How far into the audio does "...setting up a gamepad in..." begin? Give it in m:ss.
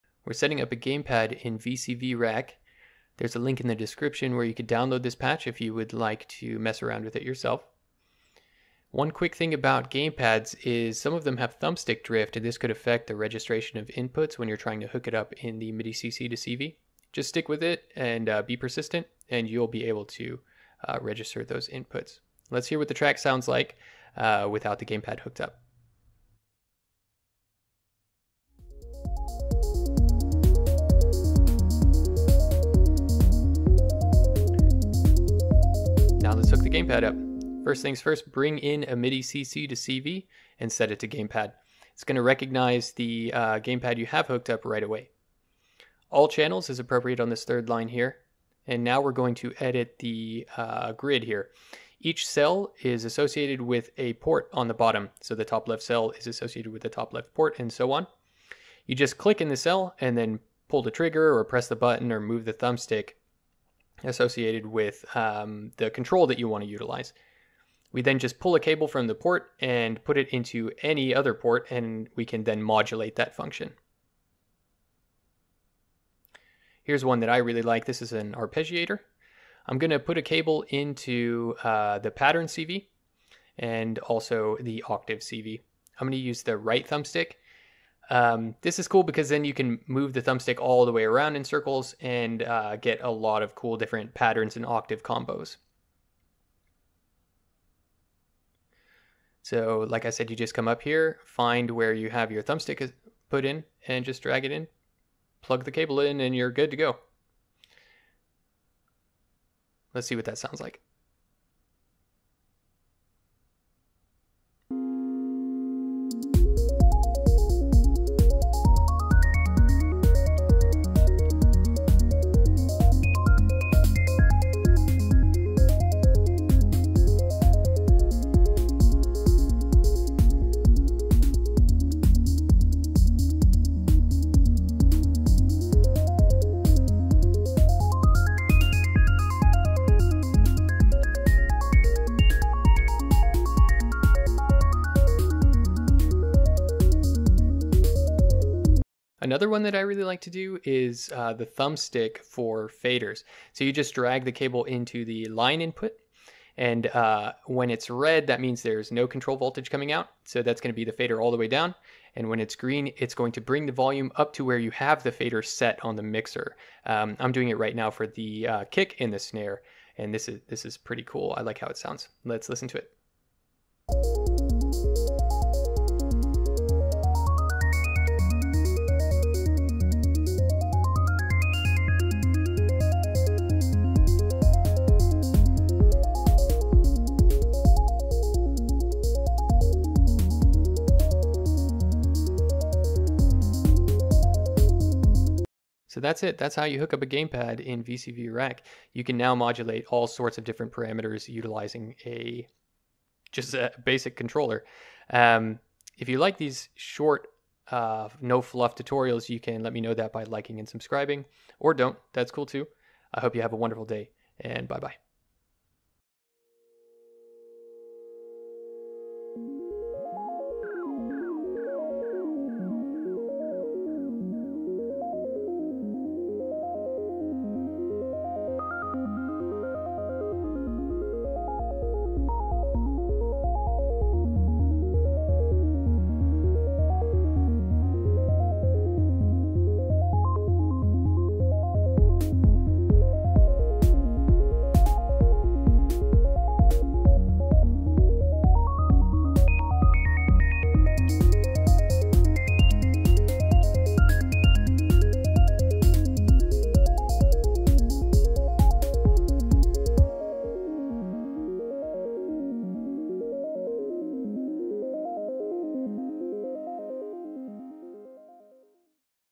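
0:00.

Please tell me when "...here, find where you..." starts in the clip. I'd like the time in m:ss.
1:40.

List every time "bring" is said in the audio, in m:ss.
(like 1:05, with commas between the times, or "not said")
0:38, 2:43.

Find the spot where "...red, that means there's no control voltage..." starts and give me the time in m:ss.
2:37.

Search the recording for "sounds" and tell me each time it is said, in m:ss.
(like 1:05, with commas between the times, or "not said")
0:23, 1:50, 2:51.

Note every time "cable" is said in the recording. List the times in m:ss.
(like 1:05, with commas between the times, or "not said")
1:08, 1:20, 1:45, 2:34.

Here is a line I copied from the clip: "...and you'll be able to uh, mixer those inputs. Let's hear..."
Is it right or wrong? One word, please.
wrong.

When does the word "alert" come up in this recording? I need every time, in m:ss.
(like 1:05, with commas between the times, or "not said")
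not said.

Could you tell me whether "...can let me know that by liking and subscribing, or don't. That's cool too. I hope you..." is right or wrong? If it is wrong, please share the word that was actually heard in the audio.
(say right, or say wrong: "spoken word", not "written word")
right.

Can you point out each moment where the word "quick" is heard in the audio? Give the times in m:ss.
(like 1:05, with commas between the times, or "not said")
0:09.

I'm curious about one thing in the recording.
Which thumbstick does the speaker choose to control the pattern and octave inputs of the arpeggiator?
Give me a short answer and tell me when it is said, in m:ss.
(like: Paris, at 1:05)
Right thumbstick, at 1:26.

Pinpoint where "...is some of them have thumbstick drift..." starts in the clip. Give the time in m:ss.
0:10.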